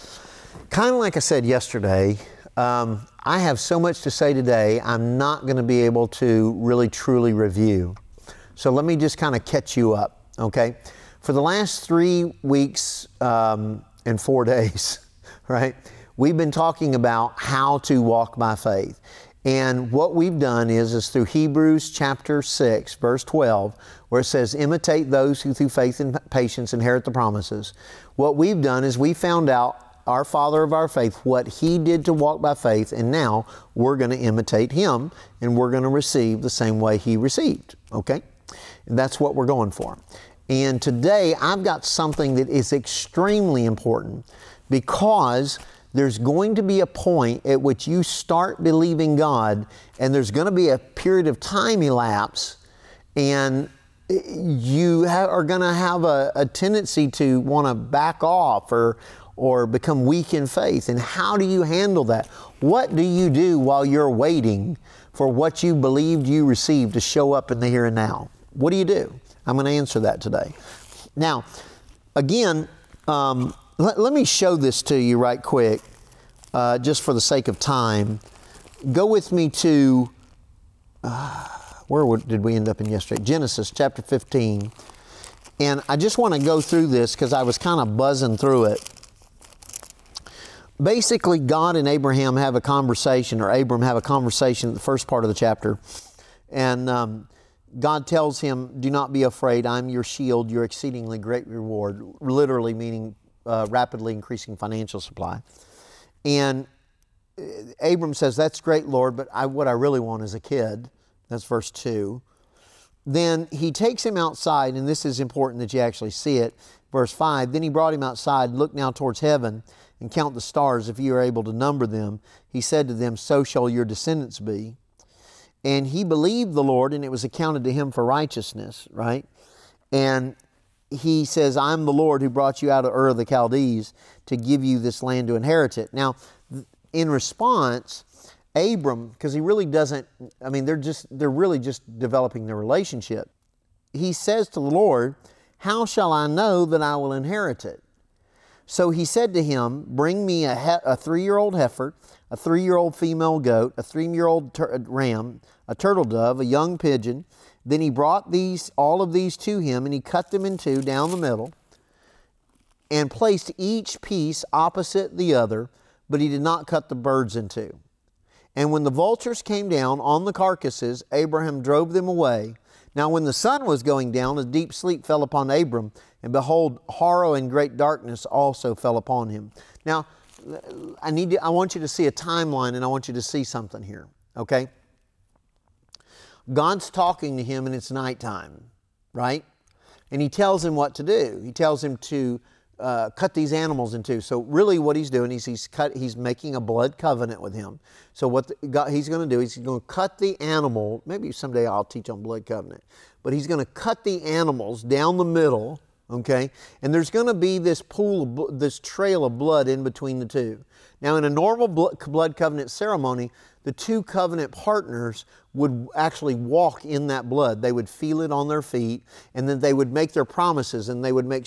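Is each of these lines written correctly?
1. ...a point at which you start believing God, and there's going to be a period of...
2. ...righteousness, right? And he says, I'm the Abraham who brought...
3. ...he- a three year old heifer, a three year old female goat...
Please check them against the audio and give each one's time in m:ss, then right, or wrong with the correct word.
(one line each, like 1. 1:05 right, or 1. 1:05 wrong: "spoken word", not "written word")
1. 0:46 right
2. 2:08 wrong: "Lord", not "Abraham"
3. 2:30 right.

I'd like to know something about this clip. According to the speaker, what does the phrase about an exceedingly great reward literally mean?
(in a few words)
rapidly increasing financial supply.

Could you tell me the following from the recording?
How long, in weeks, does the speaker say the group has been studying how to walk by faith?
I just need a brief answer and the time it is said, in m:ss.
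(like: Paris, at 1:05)
3 weeks, at 0:11.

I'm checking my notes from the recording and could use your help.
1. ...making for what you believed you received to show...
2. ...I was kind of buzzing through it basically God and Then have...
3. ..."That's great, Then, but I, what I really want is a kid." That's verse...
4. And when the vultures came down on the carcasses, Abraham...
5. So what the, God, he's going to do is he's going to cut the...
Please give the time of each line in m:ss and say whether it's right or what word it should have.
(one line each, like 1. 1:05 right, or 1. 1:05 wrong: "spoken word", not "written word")
1. 1:04 wrong: "waiting", not "making"
2. 1:27 wrong: "Abraham", not "Then"
3. 1:48 wrong: "Lord", not "Then"
4. 2:48 right
5. 3:18 right.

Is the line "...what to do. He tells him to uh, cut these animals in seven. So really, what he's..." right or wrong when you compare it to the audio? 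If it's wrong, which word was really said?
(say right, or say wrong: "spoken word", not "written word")
wrong: "two", not "seven".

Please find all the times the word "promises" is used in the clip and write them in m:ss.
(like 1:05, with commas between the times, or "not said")
0:27, 3:40.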